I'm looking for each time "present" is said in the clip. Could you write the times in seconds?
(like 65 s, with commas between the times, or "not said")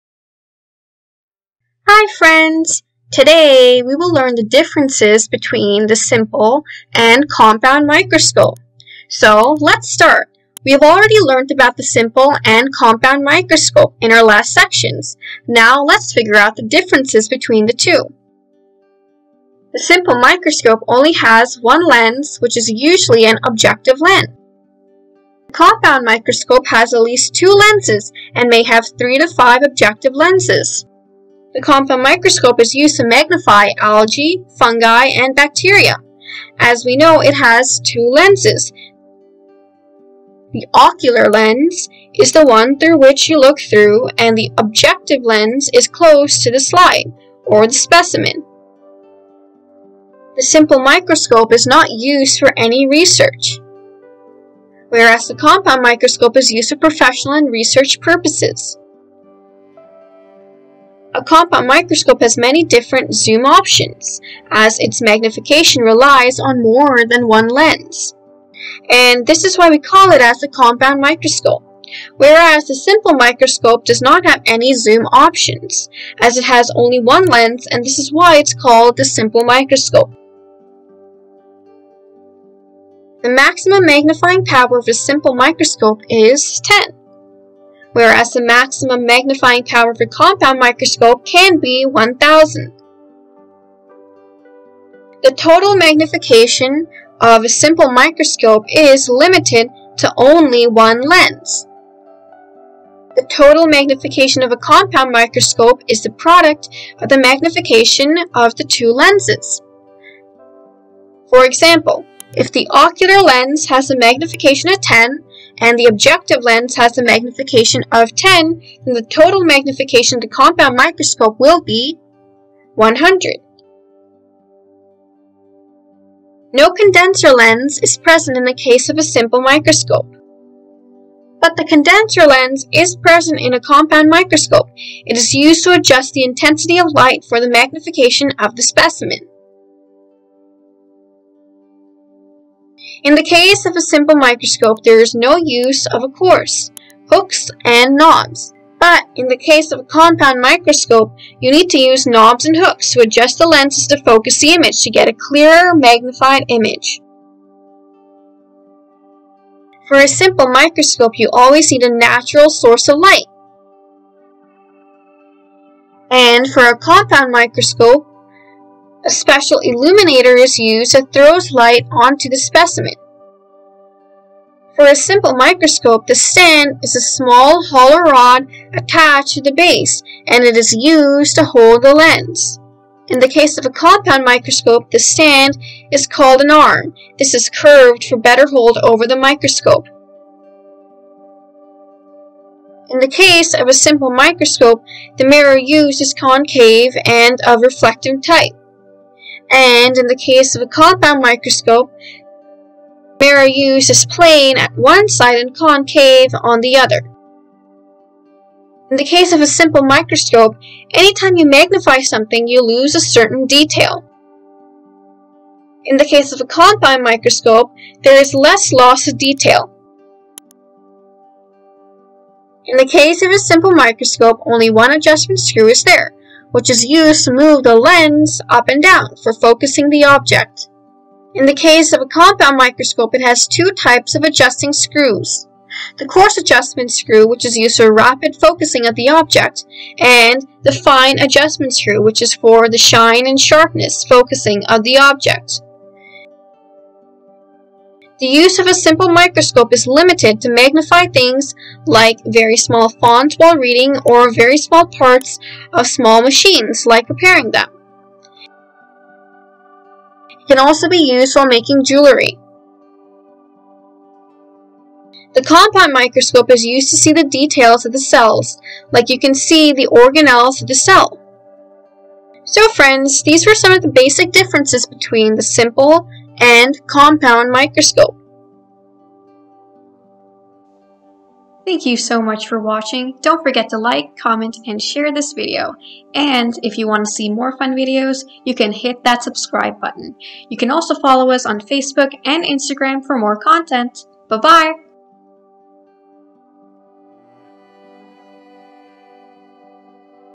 127 s, 132 s.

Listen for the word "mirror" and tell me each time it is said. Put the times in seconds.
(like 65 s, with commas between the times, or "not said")
195 s, 203 s.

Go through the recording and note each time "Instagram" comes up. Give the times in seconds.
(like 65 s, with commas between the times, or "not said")
292 s.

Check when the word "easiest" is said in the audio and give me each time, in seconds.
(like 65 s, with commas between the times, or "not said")
not said.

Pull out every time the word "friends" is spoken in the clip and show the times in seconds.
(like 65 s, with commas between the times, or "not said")
2 s, 272 s.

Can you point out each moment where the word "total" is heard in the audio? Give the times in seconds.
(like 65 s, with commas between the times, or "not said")
95 s, 103 s, 119 s.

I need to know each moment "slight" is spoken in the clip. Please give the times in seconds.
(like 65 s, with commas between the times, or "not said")
not said.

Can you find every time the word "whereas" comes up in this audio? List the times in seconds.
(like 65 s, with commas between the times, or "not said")
54 s, 72 s, 87 s.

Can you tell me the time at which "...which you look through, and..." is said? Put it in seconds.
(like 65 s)
42 s.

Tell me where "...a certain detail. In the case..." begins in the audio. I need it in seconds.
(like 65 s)
212 s.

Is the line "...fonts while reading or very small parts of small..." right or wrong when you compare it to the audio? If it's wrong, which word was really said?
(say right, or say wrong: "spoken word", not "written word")
right.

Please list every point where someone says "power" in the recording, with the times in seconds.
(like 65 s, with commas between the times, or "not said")
84 s, 89 s.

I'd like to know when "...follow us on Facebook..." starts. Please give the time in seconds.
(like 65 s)
290 s.